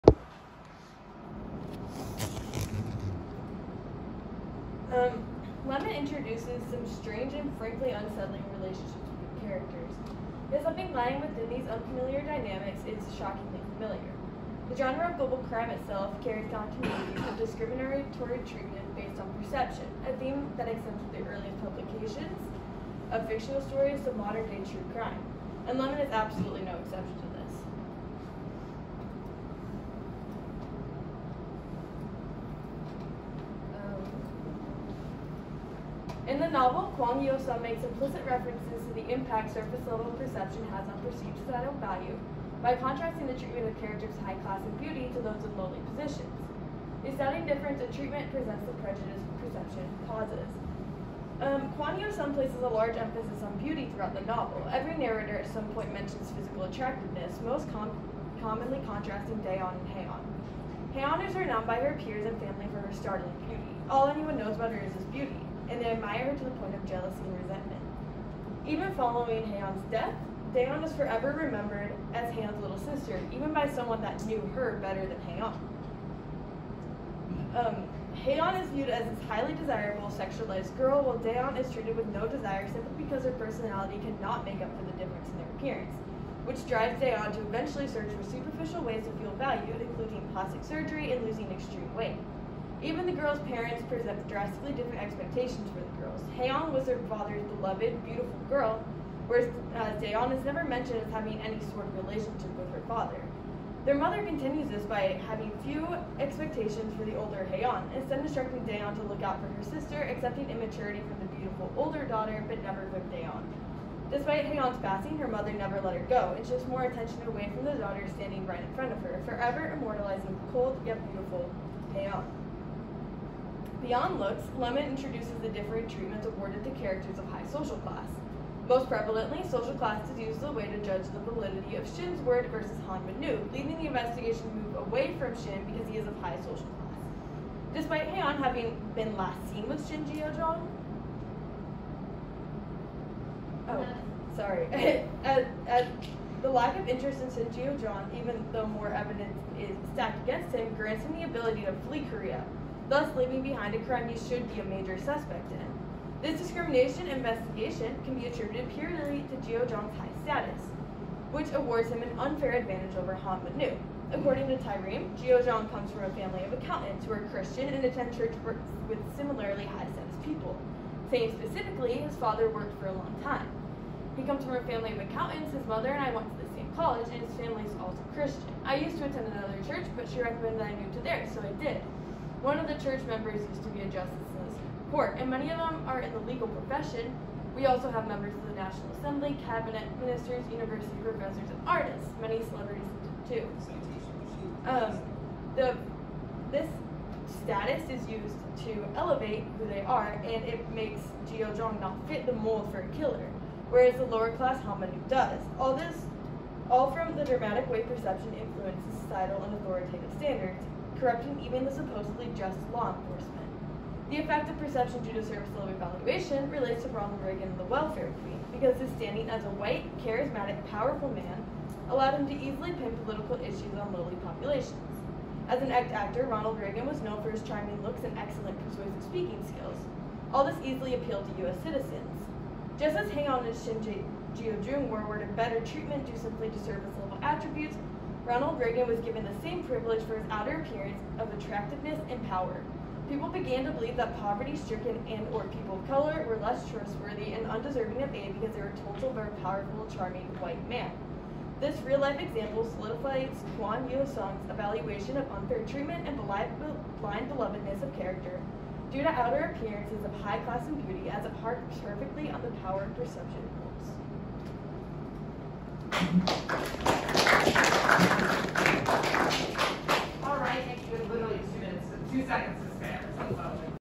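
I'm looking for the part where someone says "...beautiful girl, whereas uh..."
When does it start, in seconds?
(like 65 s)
98 s.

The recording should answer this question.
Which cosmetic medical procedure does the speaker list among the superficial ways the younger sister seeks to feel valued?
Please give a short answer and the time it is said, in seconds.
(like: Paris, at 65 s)
plastic surgery, at 90 s.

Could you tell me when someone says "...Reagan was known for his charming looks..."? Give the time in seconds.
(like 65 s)
226 s.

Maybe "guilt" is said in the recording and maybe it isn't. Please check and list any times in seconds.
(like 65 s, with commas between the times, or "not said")
not said.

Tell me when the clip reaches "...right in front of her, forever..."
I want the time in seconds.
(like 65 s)
118 s.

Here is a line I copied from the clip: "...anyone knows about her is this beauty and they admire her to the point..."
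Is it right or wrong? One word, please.
right.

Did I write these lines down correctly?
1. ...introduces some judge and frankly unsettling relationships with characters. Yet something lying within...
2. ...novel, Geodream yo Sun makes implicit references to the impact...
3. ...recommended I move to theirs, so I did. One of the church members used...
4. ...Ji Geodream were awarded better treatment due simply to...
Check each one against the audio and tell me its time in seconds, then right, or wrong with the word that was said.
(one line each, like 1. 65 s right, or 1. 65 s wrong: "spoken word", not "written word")
1. 5 s wrong: "strange", not "judge"
2. 36 s wrong: "Kwang", not "Geodream"
3. 180 s right
4. 233 s right.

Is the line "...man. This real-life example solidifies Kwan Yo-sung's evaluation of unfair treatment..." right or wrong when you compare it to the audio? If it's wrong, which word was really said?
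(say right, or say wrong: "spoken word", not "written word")
right.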